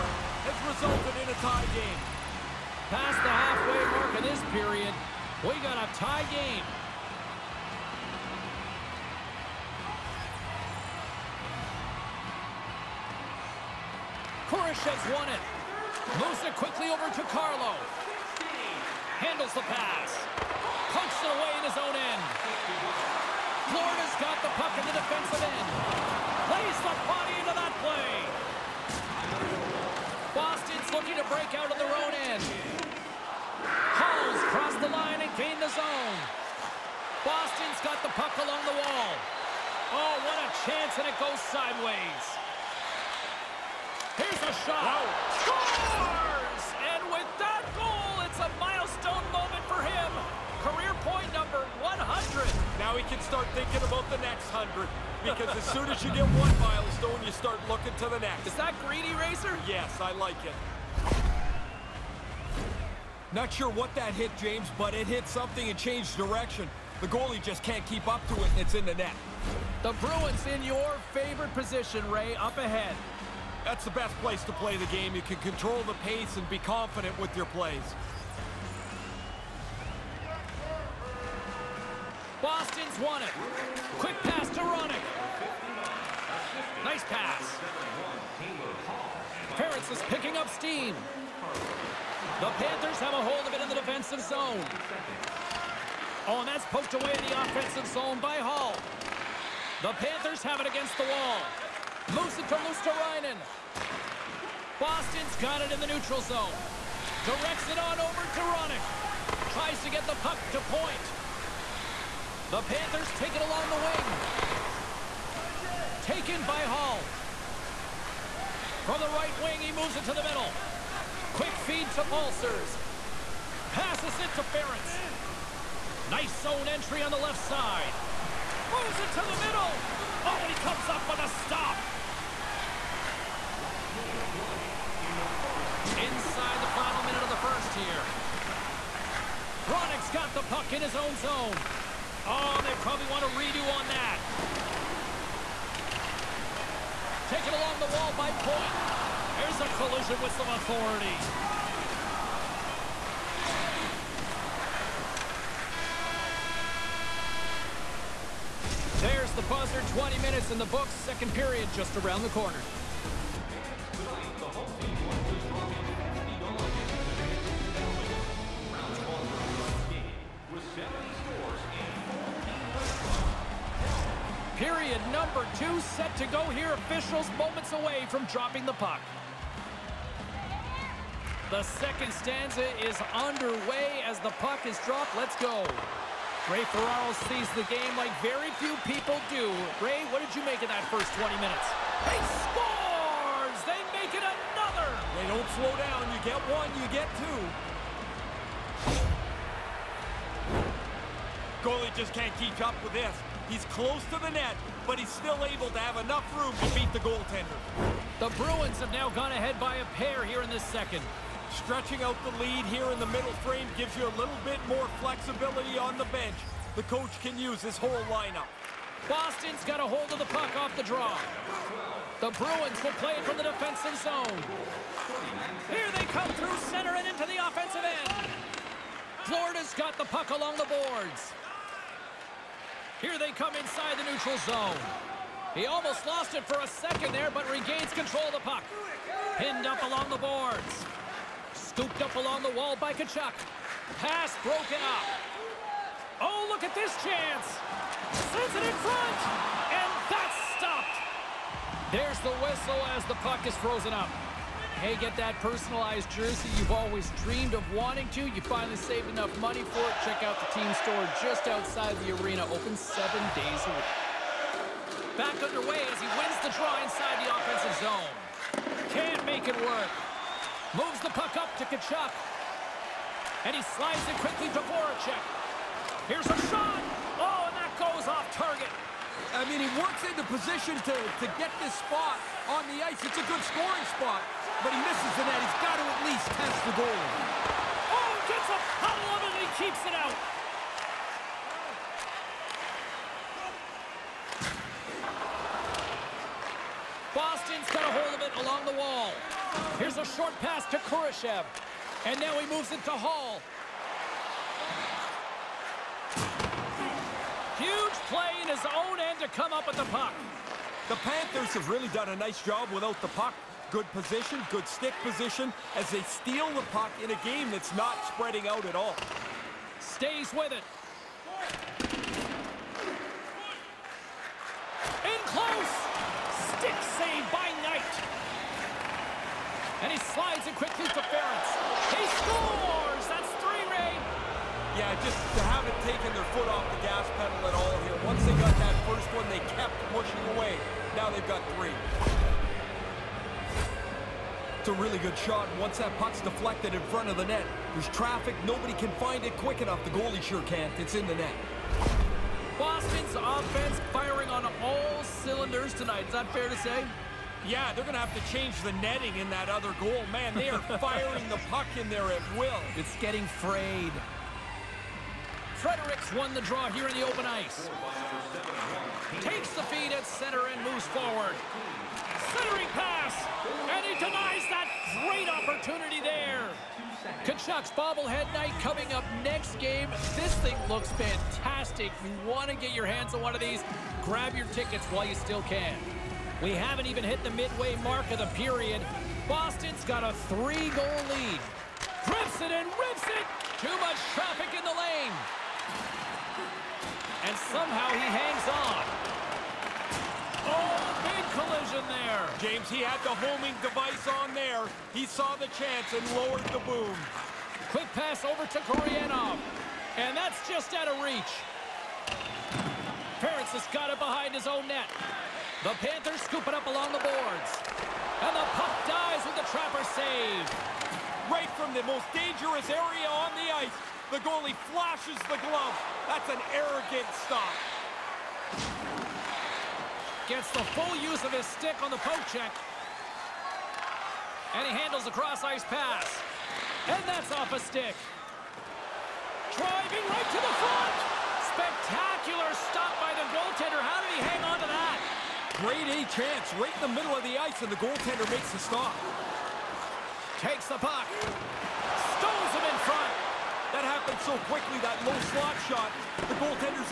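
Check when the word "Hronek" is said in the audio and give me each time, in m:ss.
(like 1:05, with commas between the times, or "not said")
1:24, 1:48, 2:19.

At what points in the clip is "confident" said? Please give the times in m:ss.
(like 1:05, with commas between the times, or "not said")
1:16.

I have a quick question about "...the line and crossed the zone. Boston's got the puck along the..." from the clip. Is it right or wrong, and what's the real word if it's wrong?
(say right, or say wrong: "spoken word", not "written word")
wrong: "gained", not "crossed".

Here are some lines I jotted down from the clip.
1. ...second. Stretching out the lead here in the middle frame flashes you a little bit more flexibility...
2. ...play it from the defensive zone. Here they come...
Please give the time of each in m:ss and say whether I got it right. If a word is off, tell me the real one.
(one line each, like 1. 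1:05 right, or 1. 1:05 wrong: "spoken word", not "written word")
1. 3:30 wrong: "gives", not "flashes"
2. 3:43 right.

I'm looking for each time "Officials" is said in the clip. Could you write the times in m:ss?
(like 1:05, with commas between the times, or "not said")
2:56.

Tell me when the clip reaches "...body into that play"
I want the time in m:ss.
0:27.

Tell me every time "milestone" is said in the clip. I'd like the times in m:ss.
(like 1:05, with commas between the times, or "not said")
0:48, 0:56.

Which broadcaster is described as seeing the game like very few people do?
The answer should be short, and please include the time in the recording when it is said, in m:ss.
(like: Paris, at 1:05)
Ray Ferraro, at 3:06.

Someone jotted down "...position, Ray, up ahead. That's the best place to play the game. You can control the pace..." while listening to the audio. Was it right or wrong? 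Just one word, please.
right.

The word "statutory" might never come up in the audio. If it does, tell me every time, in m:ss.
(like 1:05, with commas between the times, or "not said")
not said.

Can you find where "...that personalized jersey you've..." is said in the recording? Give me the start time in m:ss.
4:15.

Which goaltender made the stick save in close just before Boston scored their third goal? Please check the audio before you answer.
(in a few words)
Knight.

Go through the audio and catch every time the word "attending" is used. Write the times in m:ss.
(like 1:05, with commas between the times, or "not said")
not said.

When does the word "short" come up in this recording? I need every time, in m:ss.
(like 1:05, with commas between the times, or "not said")
5:00.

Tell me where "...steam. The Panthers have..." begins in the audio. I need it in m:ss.
1:30.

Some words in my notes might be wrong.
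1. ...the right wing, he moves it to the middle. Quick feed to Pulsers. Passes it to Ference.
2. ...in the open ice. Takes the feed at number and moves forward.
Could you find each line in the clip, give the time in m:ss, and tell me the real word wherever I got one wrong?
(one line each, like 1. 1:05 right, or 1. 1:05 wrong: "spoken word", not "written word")
1. 1:59 right
2. 6:06 wrong: "center", not "number".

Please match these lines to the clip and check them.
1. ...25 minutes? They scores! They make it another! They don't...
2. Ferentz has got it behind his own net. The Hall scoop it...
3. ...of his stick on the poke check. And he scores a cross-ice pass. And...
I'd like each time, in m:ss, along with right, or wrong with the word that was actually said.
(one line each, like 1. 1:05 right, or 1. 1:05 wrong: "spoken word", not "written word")
1. 3:11 wrong: "20", not "25"
2. 6:53 wrong: "Panthers", not "Hall"
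3. 7:11 wrong: "handles", not "scores".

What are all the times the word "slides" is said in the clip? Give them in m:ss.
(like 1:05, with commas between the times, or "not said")
4:33, 5:29.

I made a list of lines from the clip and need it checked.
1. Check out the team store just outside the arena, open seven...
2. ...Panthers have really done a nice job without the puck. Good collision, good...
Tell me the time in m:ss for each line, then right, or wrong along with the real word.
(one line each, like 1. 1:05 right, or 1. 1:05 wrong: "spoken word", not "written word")
1. 4:20 right
2. 5:10 wrong: "position", not "collision".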